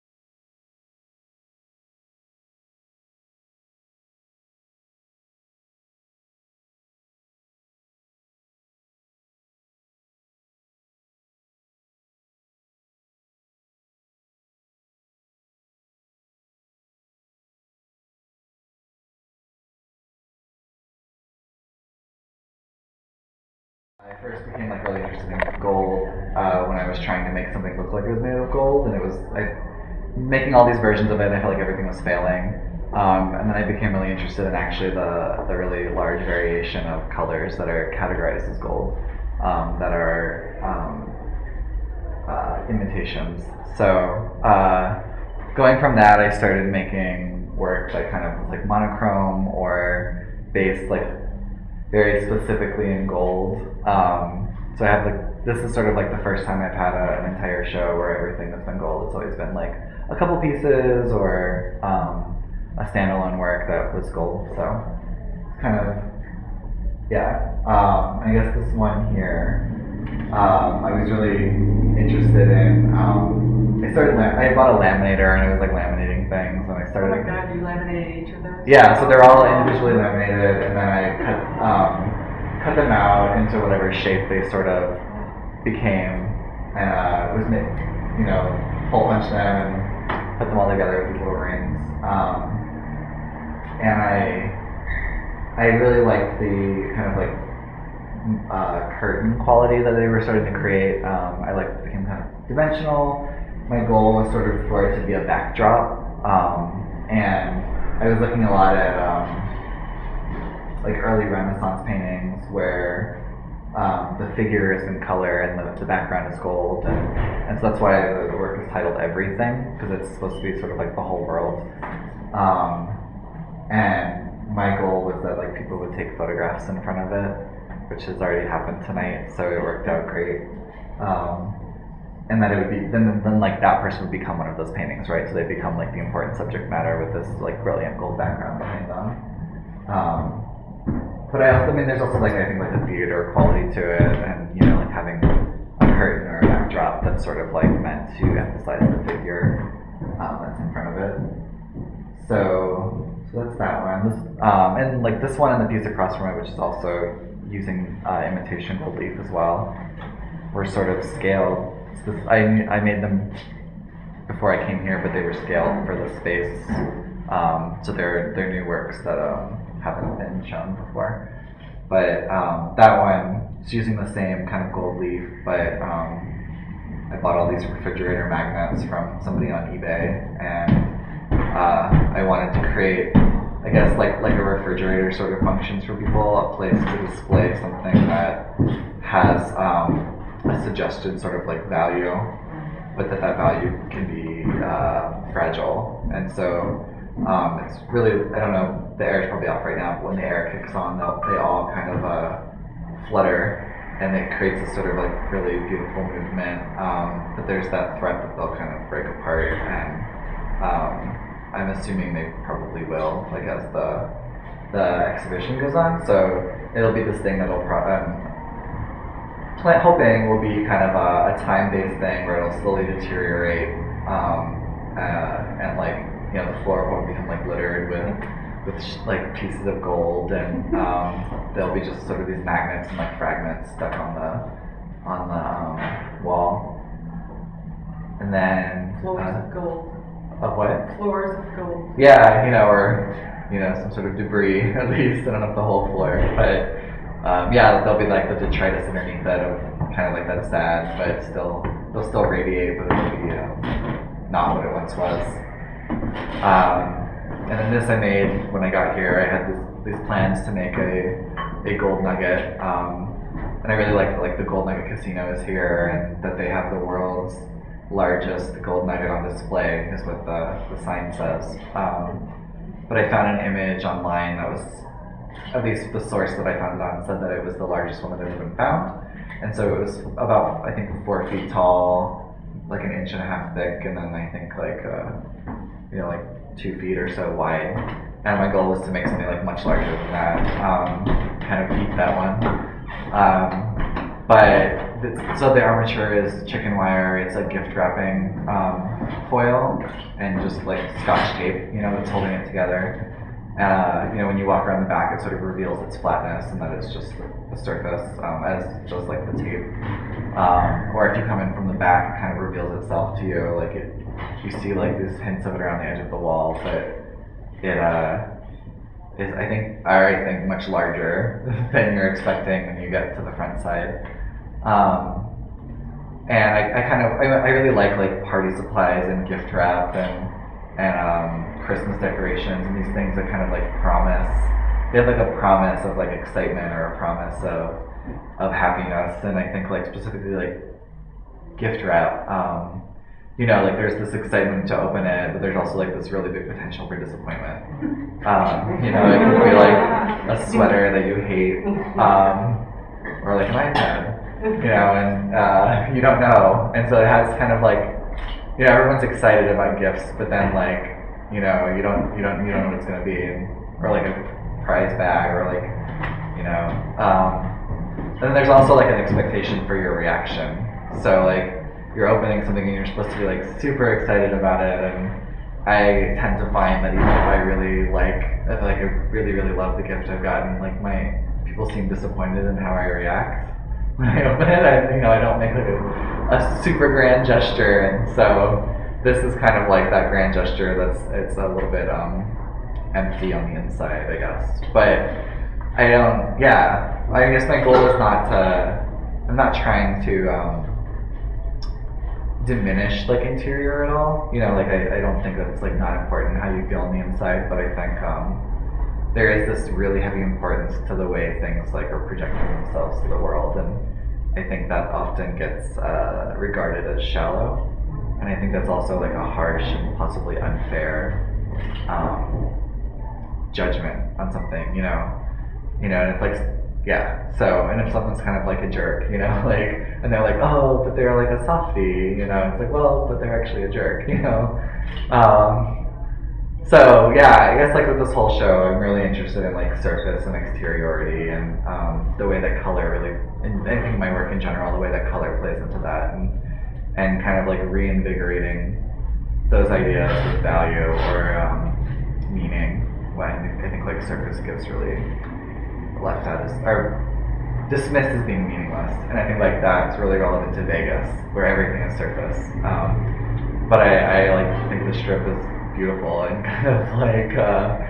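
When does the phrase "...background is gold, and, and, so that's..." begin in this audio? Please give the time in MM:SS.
01:55.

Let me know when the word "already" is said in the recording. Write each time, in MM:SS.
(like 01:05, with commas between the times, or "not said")
02:08, 05:19.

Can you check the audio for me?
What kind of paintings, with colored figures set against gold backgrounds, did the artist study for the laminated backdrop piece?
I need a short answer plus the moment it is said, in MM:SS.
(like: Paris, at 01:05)
Early Renaissance paintings, at 01:51.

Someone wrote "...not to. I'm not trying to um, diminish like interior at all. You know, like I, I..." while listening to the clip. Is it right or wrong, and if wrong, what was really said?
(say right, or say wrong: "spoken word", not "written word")
right.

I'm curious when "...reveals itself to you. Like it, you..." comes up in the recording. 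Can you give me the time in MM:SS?
05:12.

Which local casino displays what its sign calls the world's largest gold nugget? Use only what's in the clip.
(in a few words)
Gold Nugget Casino.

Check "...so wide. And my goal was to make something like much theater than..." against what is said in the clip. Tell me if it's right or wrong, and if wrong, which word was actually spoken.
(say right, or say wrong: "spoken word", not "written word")
wrong: "larger", not "theater".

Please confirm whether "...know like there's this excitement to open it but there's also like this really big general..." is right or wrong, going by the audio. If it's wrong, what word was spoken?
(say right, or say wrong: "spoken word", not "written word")
wrong: "potential", not "general".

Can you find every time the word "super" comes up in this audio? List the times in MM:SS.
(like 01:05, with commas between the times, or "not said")
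06:13, 06:26.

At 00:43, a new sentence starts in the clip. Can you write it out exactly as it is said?
So uh, going from that, I started making work that kind of was like monochrome or based like very specifically in gold.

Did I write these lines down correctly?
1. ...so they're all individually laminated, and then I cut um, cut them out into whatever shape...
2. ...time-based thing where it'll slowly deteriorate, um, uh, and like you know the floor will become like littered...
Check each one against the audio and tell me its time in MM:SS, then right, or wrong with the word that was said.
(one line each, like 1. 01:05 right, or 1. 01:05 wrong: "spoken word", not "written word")
1. 01:18 right
2. 03:41 right.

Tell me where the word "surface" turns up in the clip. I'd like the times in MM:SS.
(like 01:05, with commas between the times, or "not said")
05:07, 07:19, 07:34, 07:41.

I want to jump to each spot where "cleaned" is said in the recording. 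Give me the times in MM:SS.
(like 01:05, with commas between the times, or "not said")
not said.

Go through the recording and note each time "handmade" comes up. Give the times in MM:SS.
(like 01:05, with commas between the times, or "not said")
not said.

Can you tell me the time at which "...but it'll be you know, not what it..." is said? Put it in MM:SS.
04:12.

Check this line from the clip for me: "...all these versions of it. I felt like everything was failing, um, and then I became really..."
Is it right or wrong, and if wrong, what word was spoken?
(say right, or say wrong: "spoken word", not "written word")
right.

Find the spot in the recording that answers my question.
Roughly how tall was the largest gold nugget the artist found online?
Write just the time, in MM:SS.
04:41.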